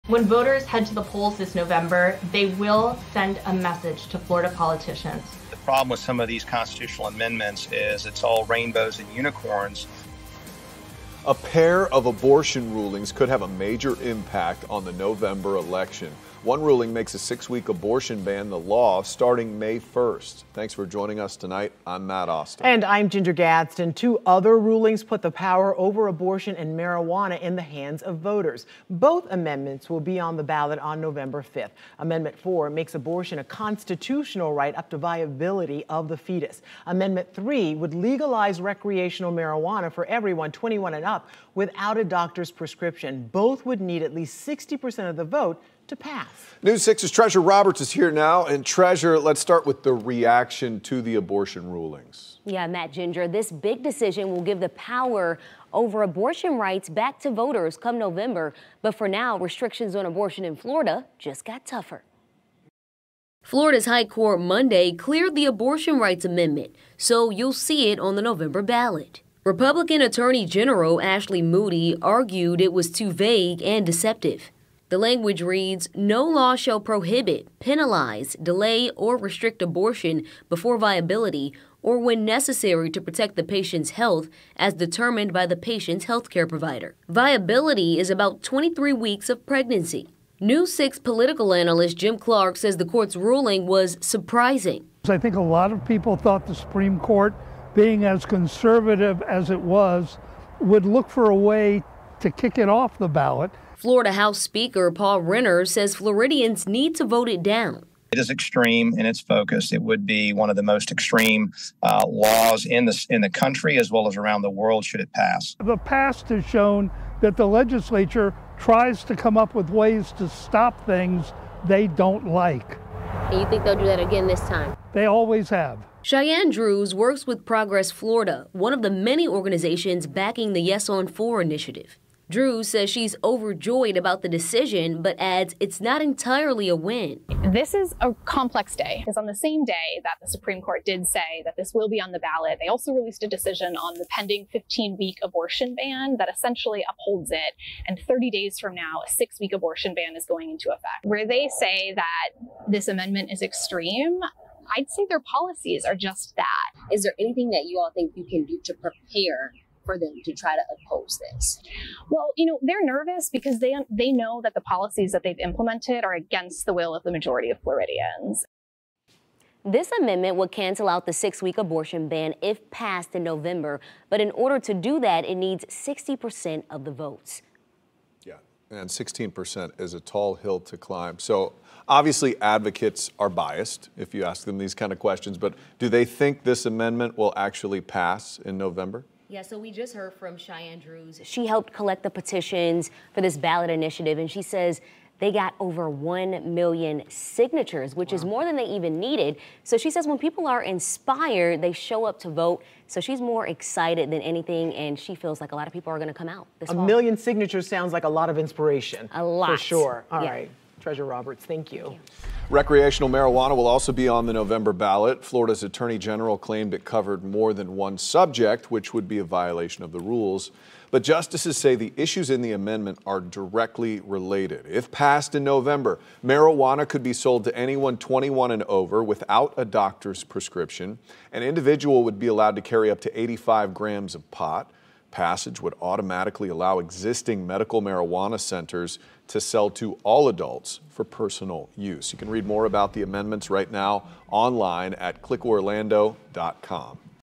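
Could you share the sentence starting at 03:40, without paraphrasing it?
But justices say the issues in the amendment are directly related.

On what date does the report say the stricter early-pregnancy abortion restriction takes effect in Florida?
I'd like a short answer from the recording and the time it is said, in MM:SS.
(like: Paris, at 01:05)
May 1st, at 00:19.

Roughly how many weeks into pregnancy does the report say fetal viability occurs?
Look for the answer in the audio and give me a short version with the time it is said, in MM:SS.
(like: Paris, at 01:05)
23 weeks, at 01:28.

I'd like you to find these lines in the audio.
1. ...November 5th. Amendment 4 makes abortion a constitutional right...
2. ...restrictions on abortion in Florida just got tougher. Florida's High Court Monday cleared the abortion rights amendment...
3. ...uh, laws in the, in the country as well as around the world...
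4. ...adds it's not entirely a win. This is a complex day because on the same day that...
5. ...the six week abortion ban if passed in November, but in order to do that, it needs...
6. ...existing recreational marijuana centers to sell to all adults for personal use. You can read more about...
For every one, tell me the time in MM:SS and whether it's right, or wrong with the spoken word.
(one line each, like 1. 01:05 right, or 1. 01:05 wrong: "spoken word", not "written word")
1. 00:30 right
2. 00:59 right
3. 01:51 right
4. 02:15 right
5. 02:51 right
6. 03:56 wrong: "medical", not "recreational".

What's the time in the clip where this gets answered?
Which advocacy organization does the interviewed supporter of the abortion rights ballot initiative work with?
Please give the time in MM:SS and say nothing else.
02:07.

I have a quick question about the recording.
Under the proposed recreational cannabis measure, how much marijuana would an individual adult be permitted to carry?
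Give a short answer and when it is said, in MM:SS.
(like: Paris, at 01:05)
85 grams, at 03:53.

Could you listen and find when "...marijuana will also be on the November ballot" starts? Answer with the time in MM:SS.
03:33.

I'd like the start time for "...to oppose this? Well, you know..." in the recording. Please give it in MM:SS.
02:40.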